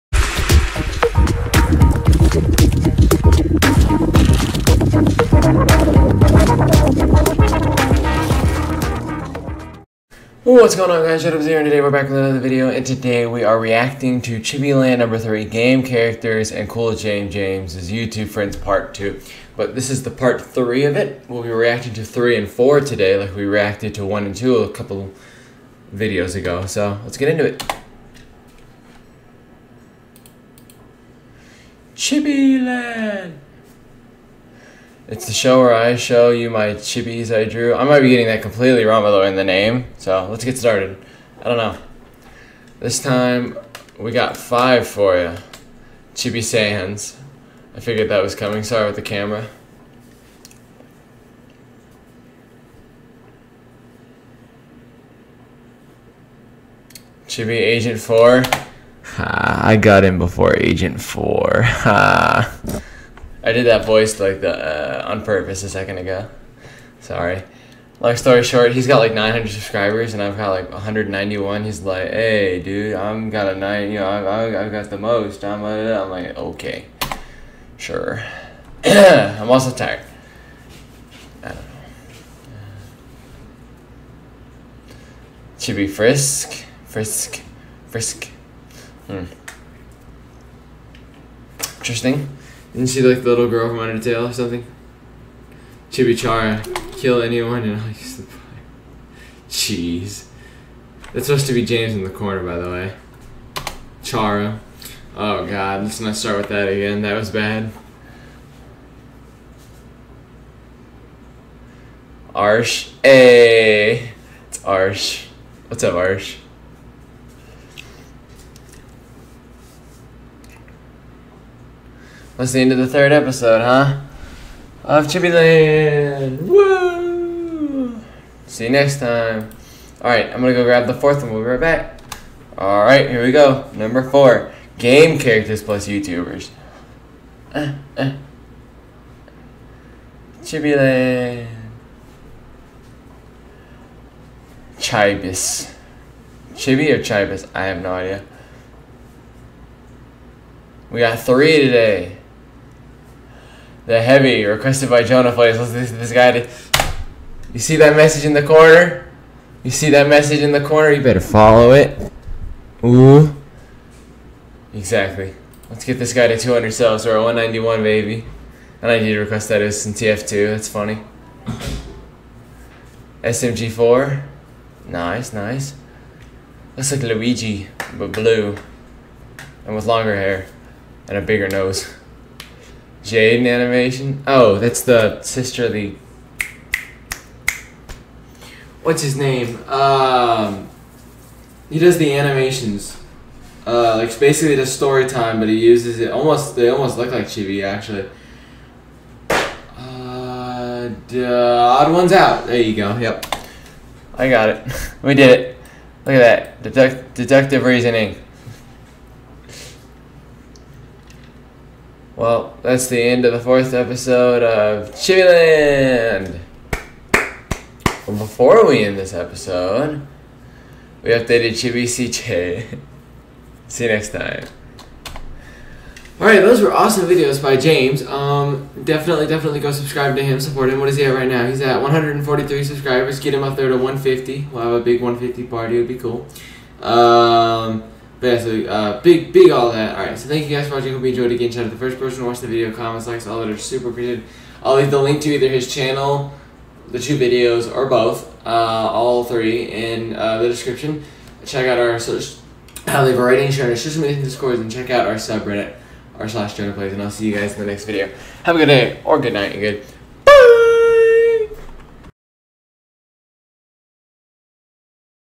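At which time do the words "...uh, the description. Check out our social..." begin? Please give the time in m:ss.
4:10.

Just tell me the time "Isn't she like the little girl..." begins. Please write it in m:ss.
1:32.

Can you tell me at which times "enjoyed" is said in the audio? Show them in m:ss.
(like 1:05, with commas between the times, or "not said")
4:01.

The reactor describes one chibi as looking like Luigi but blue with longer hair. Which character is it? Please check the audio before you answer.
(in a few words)
SMG4.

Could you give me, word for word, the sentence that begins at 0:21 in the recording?
We'll be reacting to 3 and 4 today like we reacted to 1 and 2 a couple videos ago.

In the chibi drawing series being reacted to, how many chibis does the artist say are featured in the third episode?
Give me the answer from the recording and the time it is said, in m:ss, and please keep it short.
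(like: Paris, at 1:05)
5, at 0:44.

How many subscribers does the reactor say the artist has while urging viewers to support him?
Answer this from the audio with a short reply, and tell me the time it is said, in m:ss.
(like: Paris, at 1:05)
143, at 3:51.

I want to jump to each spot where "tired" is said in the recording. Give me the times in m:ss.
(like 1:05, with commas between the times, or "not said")
1:19.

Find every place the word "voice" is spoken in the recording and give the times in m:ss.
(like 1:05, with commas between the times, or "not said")
1:03.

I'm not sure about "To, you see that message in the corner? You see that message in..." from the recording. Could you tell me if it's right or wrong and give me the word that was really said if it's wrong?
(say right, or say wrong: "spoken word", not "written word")
right.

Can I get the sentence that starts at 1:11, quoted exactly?
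He's like, "Hey, dude, I'm got a nine.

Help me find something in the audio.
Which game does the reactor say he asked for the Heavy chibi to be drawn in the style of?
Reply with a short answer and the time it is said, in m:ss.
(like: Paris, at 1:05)
TF2, at 2:49.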